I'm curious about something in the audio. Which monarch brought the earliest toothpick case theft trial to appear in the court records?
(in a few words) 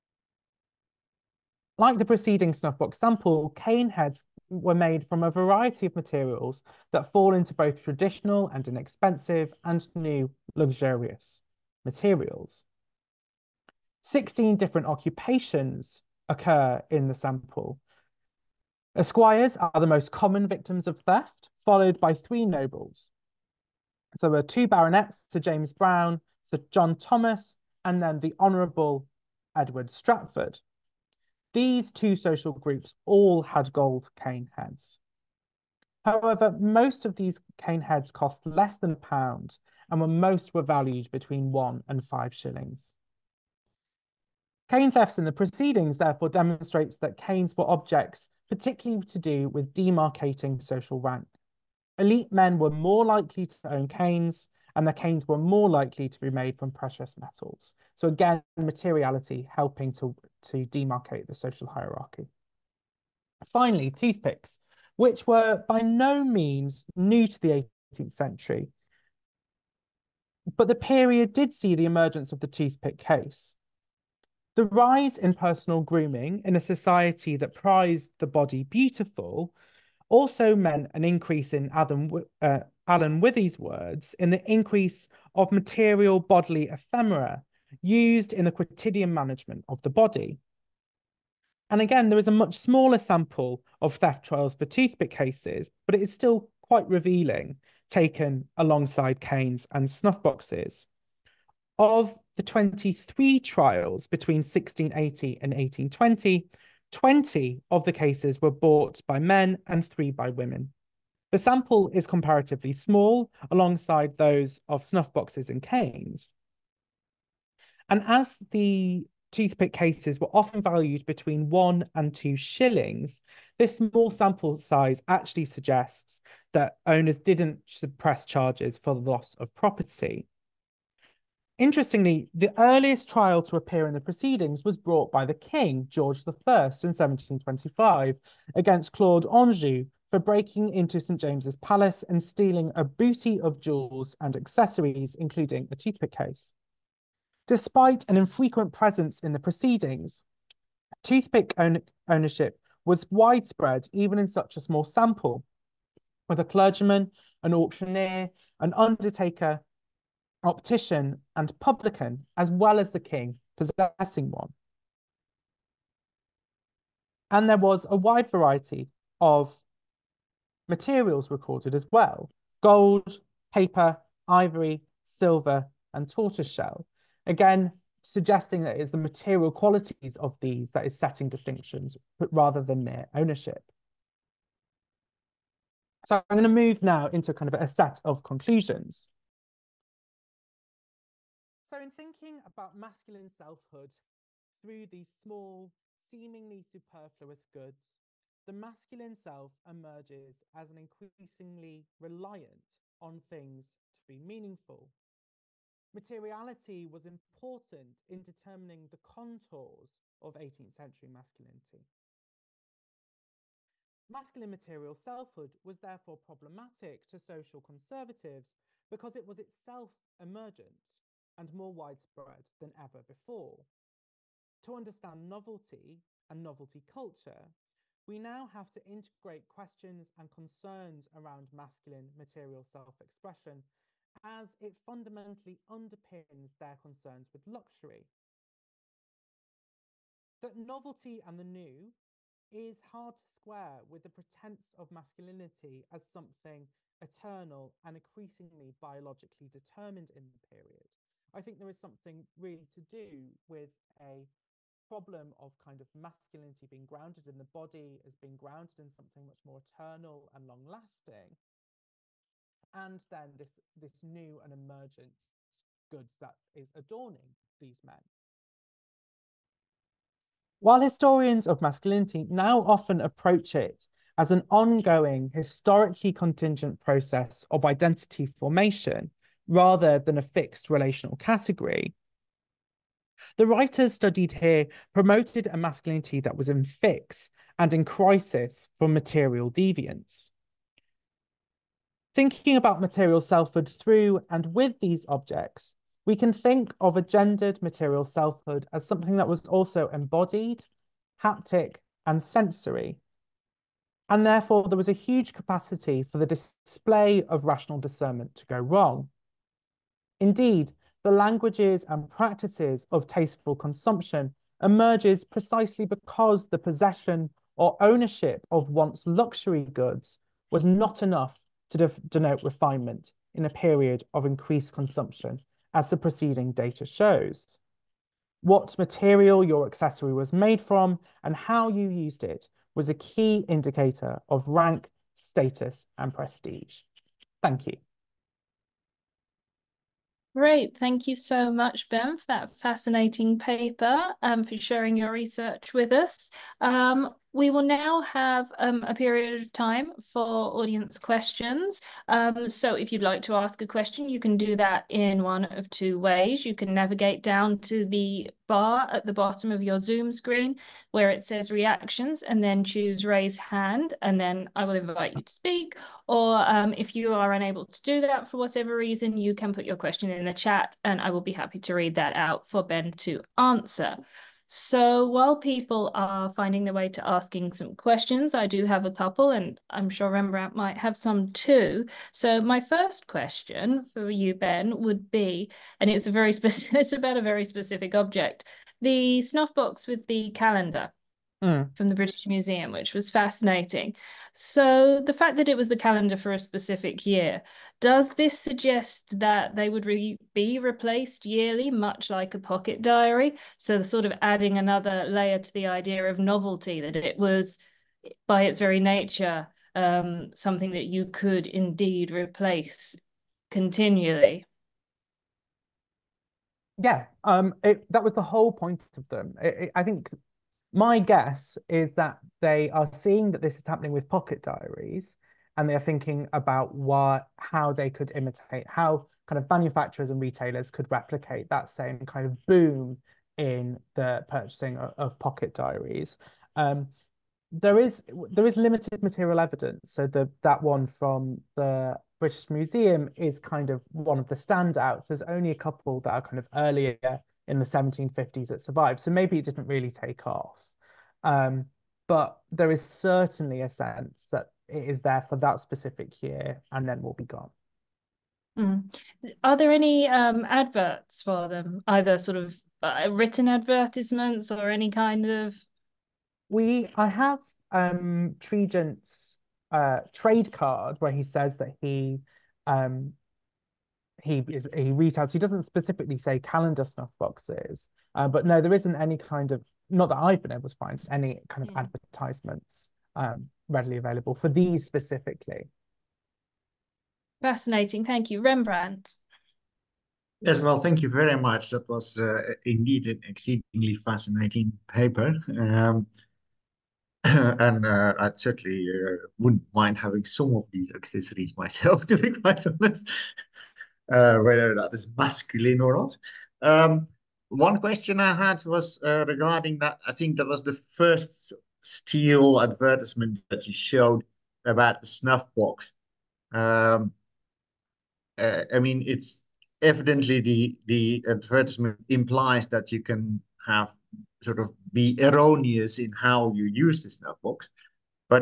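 George I.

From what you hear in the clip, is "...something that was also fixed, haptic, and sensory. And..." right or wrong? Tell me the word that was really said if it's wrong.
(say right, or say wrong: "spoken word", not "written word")
wrong: "embodied", not "fixed".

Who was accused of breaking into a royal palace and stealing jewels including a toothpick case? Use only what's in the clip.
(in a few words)
Claude Anjou.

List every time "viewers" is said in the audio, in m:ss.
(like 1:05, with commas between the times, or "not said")
not said.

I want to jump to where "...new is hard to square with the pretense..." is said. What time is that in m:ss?
4:01.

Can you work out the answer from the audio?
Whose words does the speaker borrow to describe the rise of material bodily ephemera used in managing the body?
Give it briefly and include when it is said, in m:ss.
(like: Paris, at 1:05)
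Alan Withey, at 1:22.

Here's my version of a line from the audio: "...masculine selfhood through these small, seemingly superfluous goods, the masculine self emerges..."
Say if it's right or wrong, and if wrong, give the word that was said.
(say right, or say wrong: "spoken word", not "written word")
right.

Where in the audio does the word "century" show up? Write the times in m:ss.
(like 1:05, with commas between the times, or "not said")
1:08, 3:30.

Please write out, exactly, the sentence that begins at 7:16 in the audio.
Um, there is there is limited material evidence.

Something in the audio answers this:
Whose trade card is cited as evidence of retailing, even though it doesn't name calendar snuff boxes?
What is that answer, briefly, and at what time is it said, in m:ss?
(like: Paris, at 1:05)
Tregent, at 7:48.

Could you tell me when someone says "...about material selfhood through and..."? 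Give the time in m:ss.
4:52.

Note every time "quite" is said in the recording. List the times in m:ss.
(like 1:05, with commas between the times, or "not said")
1:36, 8:22.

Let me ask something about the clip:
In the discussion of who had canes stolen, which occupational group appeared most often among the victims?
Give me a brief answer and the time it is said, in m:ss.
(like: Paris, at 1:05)
Esquires, at 0:18.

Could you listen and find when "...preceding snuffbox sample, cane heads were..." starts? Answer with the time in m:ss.
0:02.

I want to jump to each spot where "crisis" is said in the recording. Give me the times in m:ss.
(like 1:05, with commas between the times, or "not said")
4:47.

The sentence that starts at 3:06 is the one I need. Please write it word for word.
So I'm going to move now into kind of a set of conclusions.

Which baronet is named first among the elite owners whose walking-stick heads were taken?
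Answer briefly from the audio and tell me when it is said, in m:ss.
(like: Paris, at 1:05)
Sir James Brown, at 0:25.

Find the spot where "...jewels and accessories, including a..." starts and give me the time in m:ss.
2:23.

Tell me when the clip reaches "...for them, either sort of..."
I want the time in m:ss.
7:41.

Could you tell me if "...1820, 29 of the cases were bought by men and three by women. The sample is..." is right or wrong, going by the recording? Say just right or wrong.
wrong.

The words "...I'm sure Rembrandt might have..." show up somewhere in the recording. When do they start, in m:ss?
6:19.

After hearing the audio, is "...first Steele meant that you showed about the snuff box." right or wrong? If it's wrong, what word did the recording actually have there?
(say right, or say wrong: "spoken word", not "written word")
wrong: "advertisement", not "meant".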